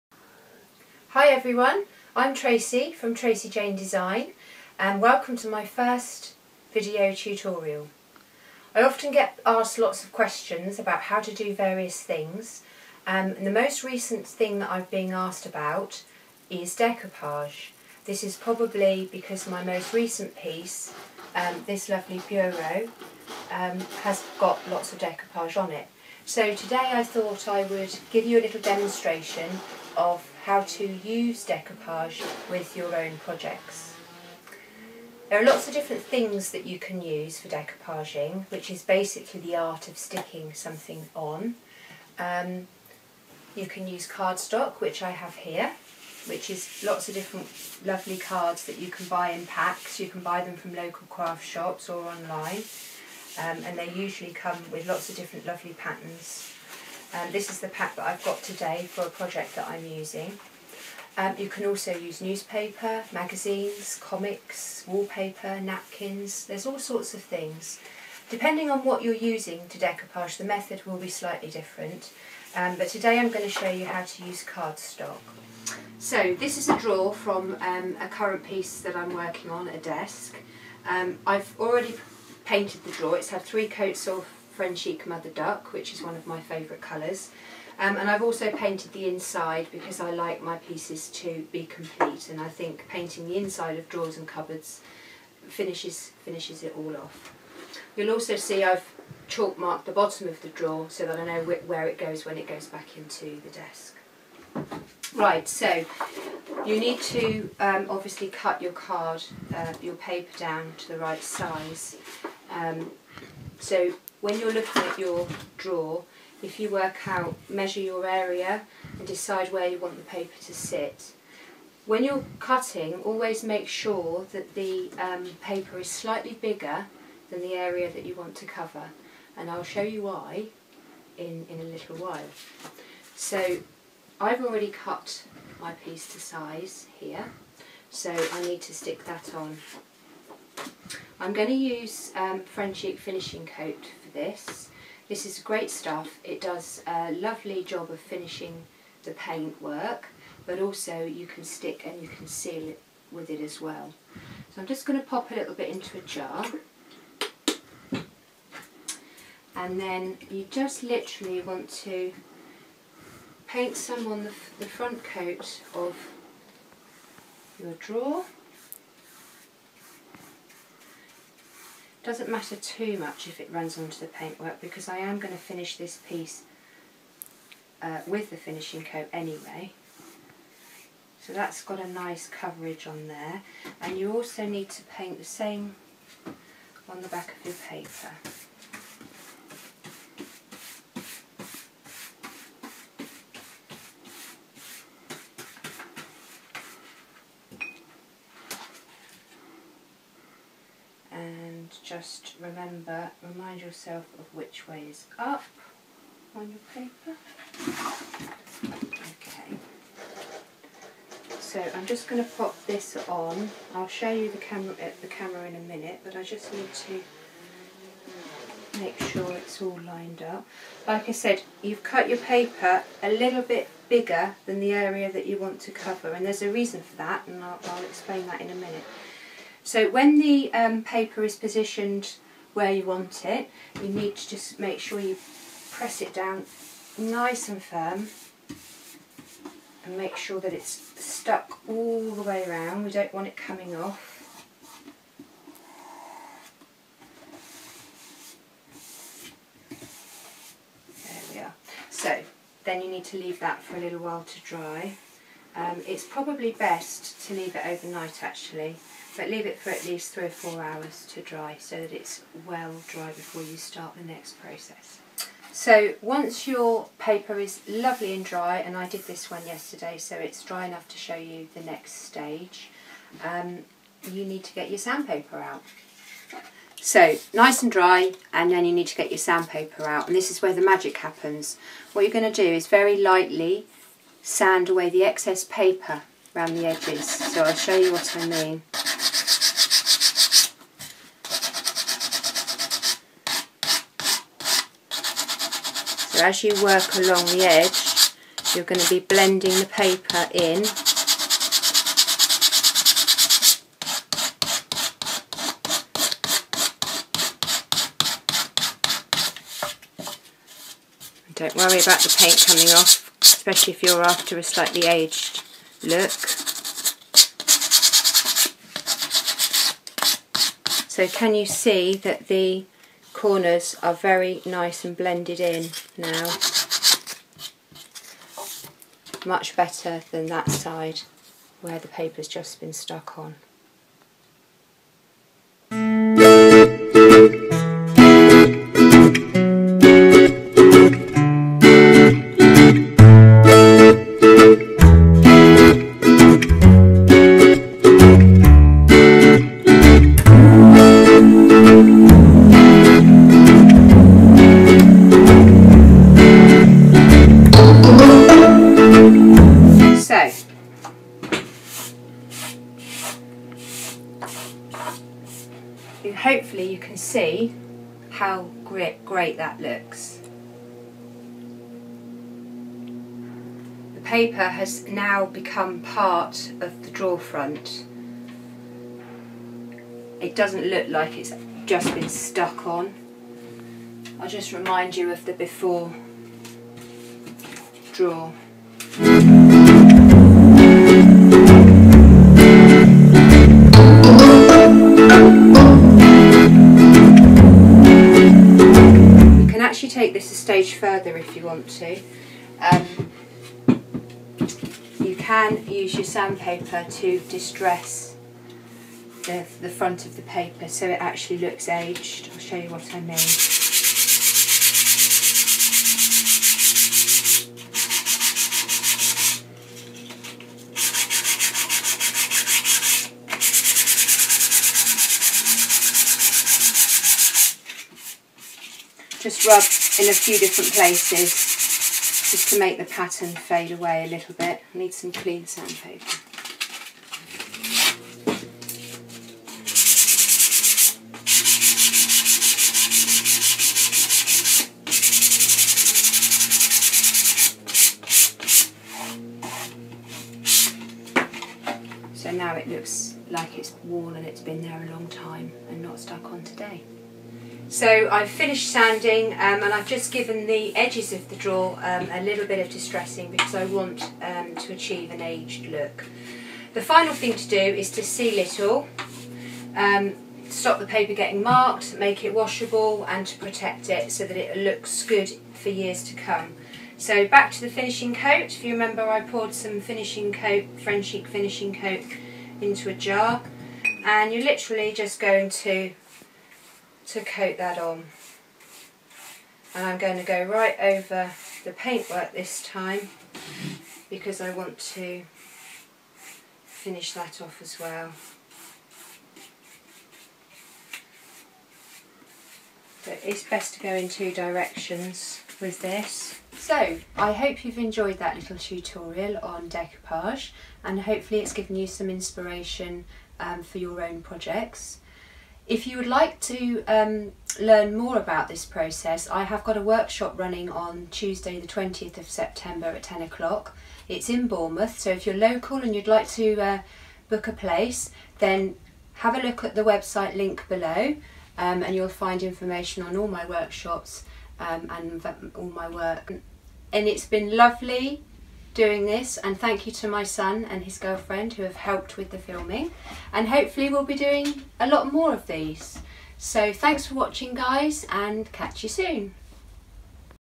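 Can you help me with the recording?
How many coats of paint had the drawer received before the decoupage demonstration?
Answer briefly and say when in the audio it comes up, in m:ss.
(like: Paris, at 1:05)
3, at 1:23.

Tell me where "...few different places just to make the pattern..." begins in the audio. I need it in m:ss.
7:10.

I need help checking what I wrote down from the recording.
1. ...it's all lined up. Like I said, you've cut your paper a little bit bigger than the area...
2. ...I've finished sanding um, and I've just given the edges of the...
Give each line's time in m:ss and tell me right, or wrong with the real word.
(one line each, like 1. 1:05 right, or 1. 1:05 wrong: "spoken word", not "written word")
1. 3:39 right
2. 7:38 right.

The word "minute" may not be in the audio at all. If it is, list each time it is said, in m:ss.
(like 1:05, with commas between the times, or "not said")
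3:35, 3:48.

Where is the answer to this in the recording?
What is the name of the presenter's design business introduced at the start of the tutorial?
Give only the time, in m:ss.
0:03.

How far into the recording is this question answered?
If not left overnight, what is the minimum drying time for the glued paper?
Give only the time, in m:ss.
4:20.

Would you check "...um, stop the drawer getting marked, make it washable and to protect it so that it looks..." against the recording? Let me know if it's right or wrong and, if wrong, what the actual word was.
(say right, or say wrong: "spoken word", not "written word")
wrong: "paper", not "drawer".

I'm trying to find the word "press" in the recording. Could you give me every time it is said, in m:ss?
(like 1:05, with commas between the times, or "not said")
3:55.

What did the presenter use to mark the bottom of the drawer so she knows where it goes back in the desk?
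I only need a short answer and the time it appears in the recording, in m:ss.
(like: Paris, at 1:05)
chalk, at 1:39.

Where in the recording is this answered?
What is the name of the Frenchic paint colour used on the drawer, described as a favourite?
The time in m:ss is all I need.
1:25.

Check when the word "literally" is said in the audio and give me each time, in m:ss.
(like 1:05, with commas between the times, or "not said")
2:40, 8:04.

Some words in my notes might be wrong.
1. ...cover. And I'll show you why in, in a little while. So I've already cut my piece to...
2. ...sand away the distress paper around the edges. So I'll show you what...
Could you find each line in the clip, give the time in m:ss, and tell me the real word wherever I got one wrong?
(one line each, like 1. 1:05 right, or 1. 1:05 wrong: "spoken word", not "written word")
1. 2:08 right
2. 4:44 wrong: "excess", not "distress".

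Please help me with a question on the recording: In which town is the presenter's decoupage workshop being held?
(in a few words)
Bournemouth.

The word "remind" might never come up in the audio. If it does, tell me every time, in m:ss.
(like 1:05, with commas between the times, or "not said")
3:23, 6:24.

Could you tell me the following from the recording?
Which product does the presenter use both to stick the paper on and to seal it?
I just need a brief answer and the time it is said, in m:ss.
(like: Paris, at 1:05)
French Finishing Coat, at 2:22.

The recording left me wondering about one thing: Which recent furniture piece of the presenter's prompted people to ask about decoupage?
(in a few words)
bureau.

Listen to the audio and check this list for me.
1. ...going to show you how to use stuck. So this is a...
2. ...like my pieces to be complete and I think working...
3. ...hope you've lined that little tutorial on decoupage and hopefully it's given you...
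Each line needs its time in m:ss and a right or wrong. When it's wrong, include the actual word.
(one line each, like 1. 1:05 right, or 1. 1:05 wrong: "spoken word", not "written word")
1. 1:13 wrong: "cardstock", not "stuck"
2. 1:30 wrong: "painting", not "working"
3. 8:27 wrong: "enjoyed", not "lined".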